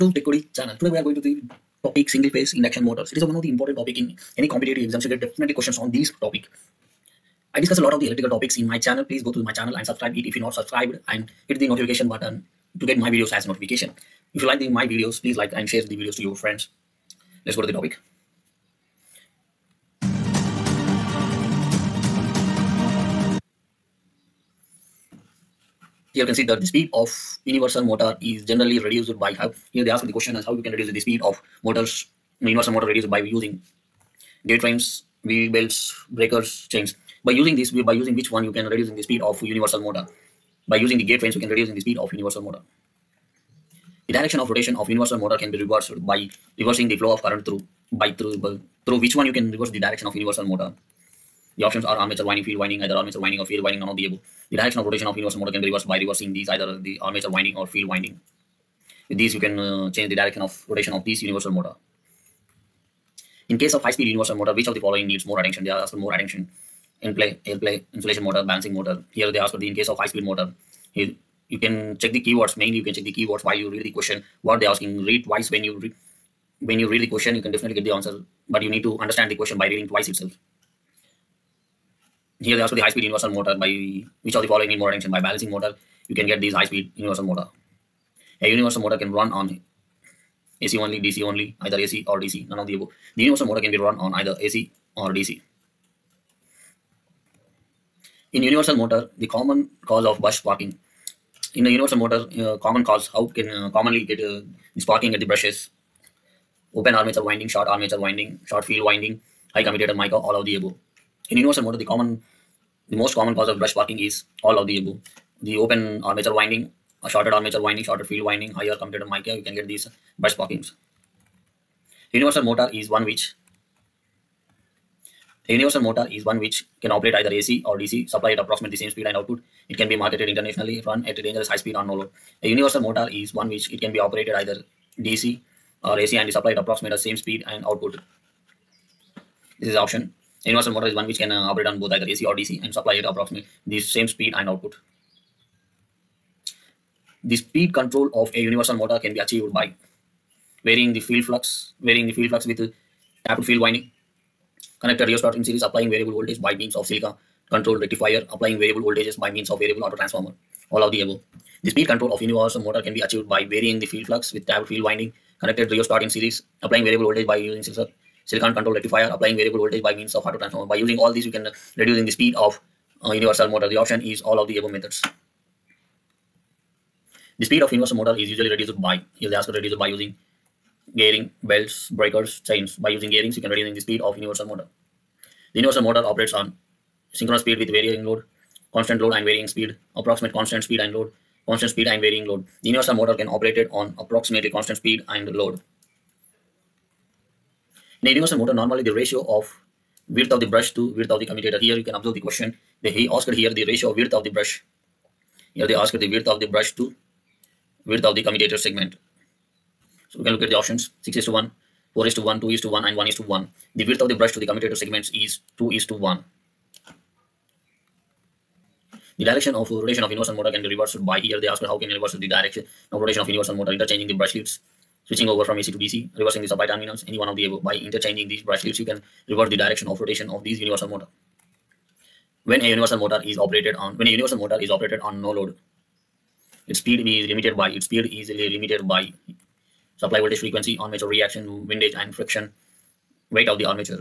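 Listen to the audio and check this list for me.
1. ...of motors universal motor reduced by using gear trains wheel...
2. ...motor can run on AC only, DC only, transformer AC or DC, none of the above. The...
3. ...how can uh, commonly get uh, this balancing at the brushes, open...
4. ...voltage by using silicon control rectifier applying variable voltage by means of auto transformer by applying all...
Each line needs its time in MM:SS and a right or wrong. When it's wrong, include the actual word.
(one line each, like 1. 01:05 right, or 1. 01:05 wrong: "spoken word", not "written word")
1. 00:31 right
2. 01:28 wrong: "either", not "transformer"
3. 01:43 wrong: "parking", not "balancing"
4. 02:47 wrong: "using", not "applying".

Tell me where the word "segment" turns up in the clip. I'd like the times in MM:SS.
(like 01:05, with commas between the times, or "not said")
03:28, 03:34.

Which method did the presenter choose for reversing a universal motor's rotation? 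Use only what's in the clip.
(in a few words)
Interchanging the brush leads.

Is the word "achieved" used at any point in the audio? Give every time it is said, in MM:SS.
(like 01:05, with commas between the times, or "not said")
02:29, 02:42.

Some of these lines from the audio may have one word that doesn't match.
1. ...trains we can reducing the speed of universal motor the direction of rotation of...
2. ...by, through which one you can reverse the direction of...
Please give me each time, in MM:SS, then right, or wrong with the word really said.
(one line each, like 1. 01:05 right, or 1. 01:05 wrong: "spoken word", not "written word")
1. 00:41 right
2. 00:48 right.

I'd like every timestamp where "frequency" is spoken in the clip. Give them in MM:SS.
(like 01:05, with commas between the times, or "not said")
04:00.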